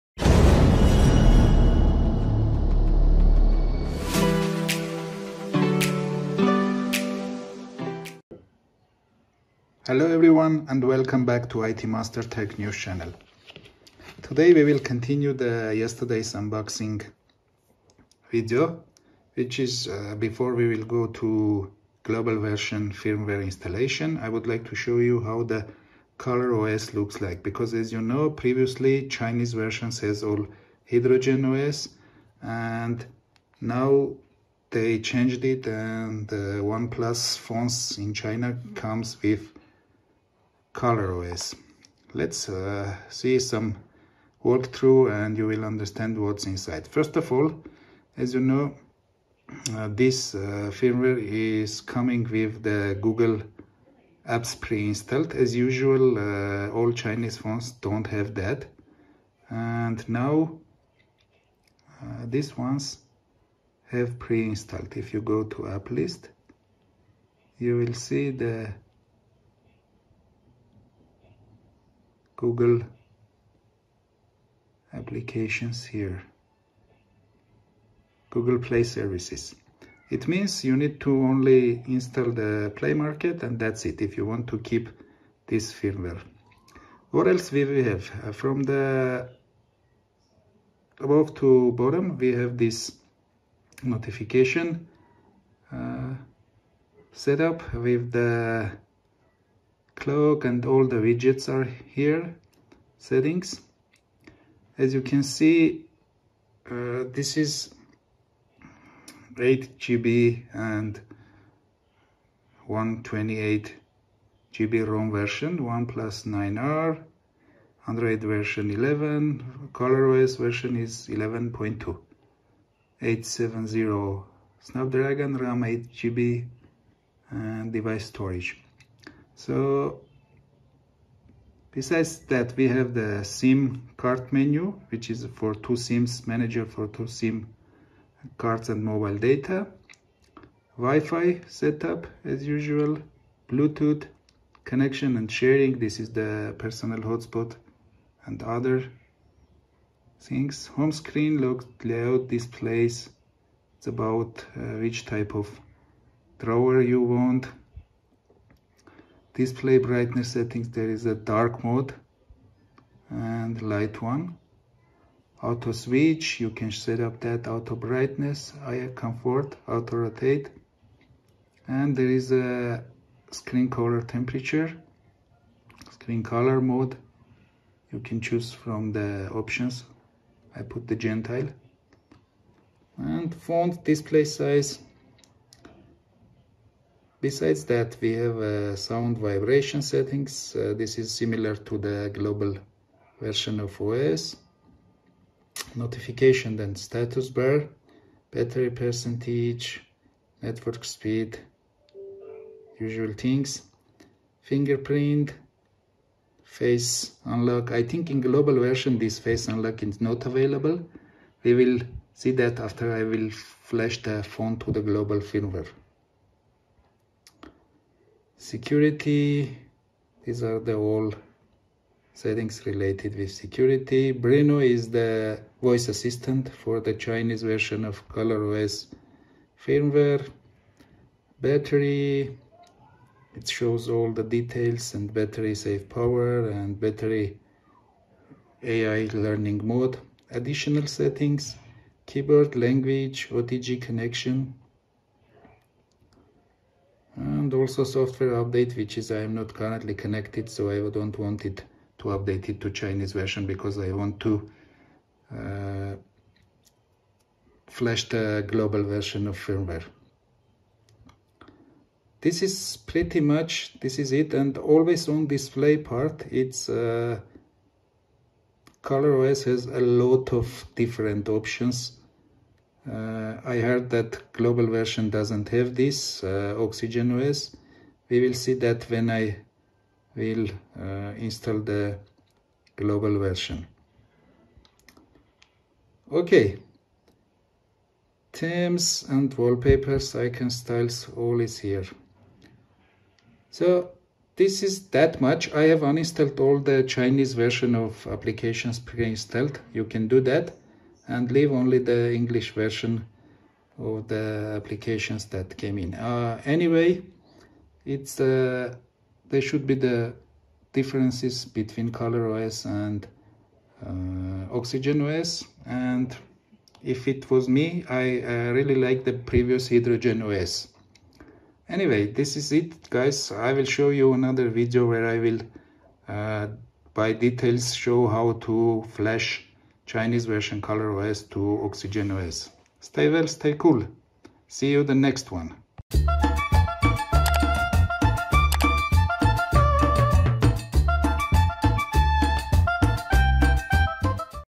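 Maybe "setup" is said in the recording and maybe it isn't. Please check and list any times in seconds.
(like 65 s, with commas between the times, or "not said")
97 s, 141 s.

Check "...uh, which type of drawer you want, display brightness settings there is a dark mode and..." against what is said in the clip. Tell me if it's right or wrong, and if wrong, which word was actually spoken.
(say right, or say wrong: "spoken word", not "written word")
right.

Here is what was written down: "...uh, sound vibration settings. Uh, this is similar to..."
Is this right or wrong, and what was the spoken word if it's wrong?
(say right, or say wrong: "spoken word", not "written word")
right.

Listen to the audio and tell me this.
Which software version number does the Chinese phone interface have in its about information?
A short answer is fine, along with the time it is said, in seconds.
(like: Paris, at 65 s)
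11.2, at 119 s.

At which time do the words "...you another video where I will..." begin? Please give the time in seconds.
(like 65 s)
323 s.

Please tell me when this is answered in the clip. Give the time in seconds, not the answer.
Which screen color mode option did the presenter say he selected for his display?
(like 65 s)
180 s.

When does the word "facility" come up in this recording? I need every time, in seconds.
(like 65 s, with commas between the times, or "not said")
not said.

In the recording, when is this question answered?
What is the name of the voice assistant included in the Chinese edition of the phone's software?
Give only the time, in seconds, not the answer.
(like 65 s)
224 s.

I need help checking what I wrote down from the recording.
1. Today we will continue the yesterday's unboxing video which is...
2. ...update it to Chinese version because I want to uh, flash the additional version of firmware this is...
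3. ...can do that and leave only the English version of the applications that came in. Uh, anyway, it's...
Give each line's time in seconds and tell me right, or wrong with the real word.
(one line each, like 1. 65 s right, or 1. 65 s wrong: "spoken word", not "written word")
1. 14 s right
2. 252 s wrong: "global", not "additional"
3. 299 s right.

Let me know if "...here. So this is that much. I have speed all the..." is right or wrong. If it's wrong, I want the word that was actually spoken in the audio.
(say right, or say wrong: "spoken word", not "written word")
wrong: "uninstalled", not "speed".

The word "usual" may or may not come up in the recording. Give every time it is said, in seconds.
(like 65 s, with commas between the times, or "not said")
55 s, 142 s, 202 s.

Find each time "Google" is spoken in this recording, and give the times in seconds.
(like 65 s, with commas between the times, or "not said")
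53 s, 72 s, 78 s.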